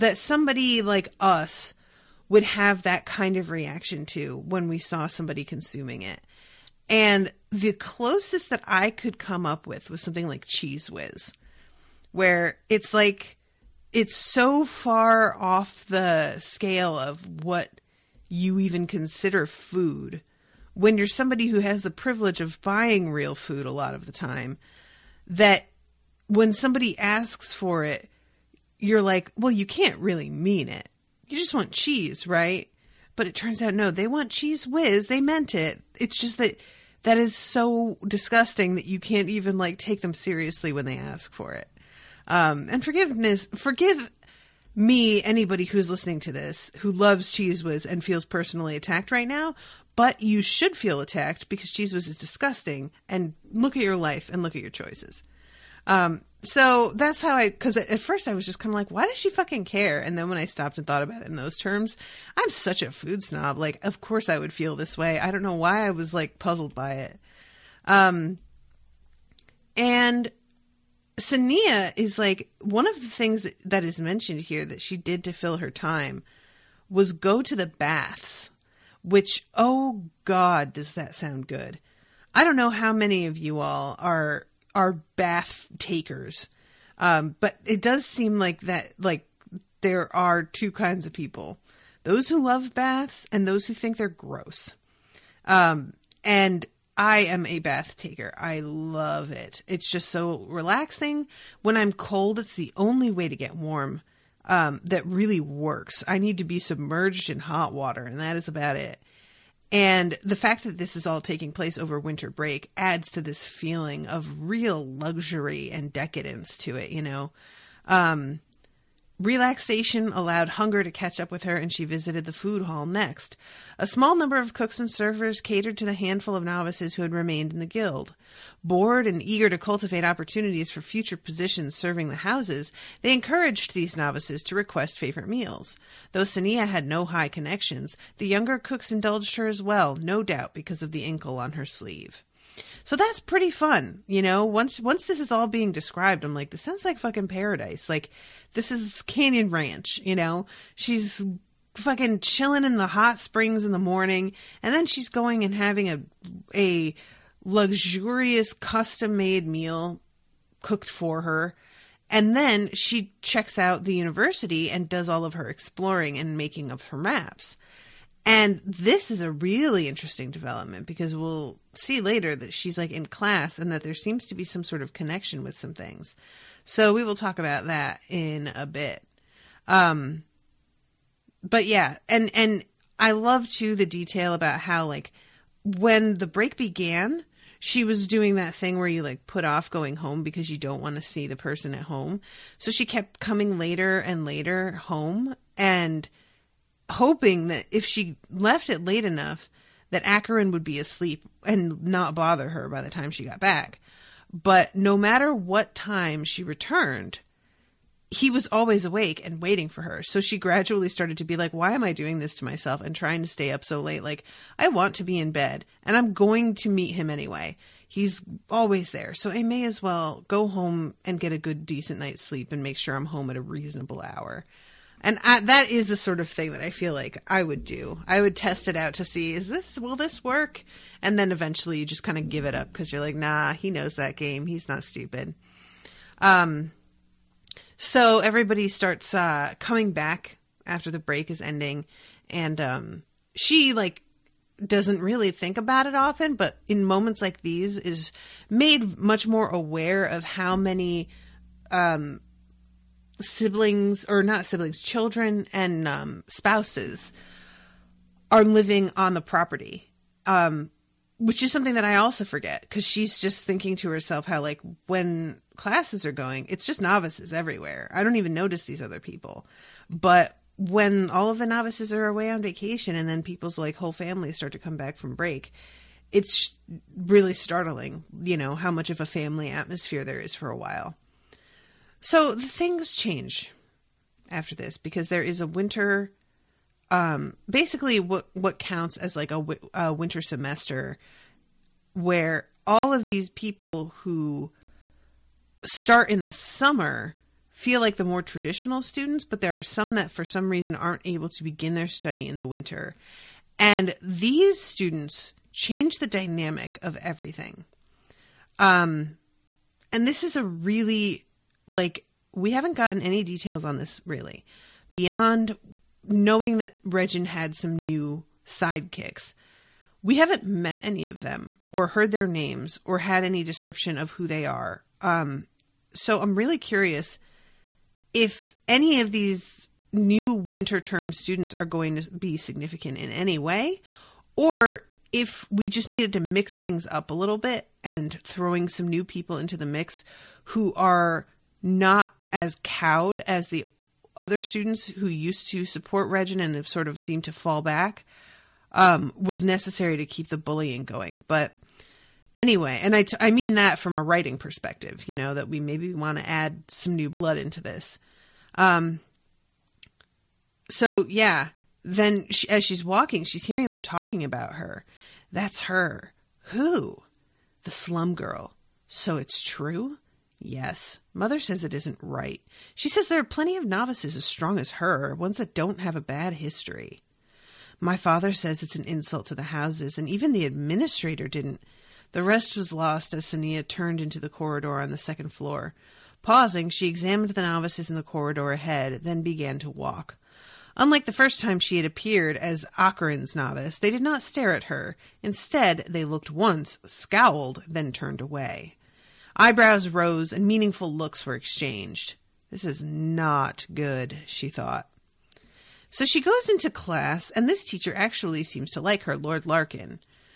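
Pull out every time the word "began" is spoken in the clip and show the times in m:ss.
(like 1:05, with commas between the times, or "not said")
3:06, 6:29.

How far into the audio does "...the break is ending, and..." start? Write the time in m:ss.
4:00.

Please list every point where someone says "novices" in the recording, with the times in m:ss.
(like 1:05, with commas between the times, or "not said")
2:06, 2:13, 4:26, 4:31, 6:13, 6:27, 6:33.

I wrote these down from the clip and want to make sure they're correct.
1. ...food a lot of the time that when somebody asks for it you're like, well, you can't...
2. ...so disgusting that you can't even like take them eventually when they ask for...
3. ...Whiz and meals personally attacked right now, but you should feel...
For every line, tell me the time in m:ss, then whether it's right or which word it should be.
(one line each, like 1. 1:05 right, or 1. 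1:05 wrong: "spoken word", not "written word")
1. 0:23 right
2. 0:37 wrong: "seriously", not "eventually"
3. 0:47 wrong: "feels", not "meals".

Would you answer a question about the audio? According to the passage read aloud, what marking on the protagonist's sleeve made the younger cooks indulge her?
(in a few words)
the incal.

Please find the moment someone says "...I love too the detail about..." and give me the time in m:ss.
3:02.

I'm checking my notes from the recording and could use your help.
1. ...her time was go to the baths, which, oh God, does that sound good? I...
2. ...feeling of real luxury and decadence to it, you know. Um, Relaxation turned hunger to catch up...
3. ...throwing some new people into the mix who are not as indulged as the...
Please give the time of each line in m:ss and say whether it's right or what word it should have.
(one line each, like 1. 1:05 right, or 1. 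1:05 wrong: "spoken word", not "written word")
1. 1:15 right
2. 1:53 wrong: "allowed", not "turned"
3. 5:38 wrong: "cowed", not "indulged".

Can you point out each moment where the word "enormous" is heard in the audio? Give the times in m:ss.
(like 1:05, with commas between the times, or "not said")
not said.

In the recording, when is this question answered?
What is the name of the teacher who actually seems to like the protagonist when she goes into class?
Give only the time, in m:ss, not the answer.
6:49.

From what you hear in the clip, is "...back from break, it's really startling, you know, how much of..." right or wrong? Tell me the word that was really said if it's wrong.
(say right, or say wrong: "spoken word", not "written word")
right.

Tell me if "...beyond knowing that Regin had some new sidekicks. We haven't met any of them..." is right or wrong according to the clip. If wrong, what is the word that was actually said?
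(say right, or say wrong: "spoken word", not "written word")
right.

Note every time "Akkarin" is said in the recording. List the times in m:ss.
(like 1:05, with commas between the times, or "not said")
3:20, 6:32.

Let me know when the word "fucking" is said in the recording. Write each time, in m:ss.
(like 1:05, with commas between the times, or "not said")
0:59, 2:26, 2:31.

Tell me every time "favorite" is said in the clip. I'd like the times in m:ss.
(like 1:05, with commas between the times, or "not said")
2:14.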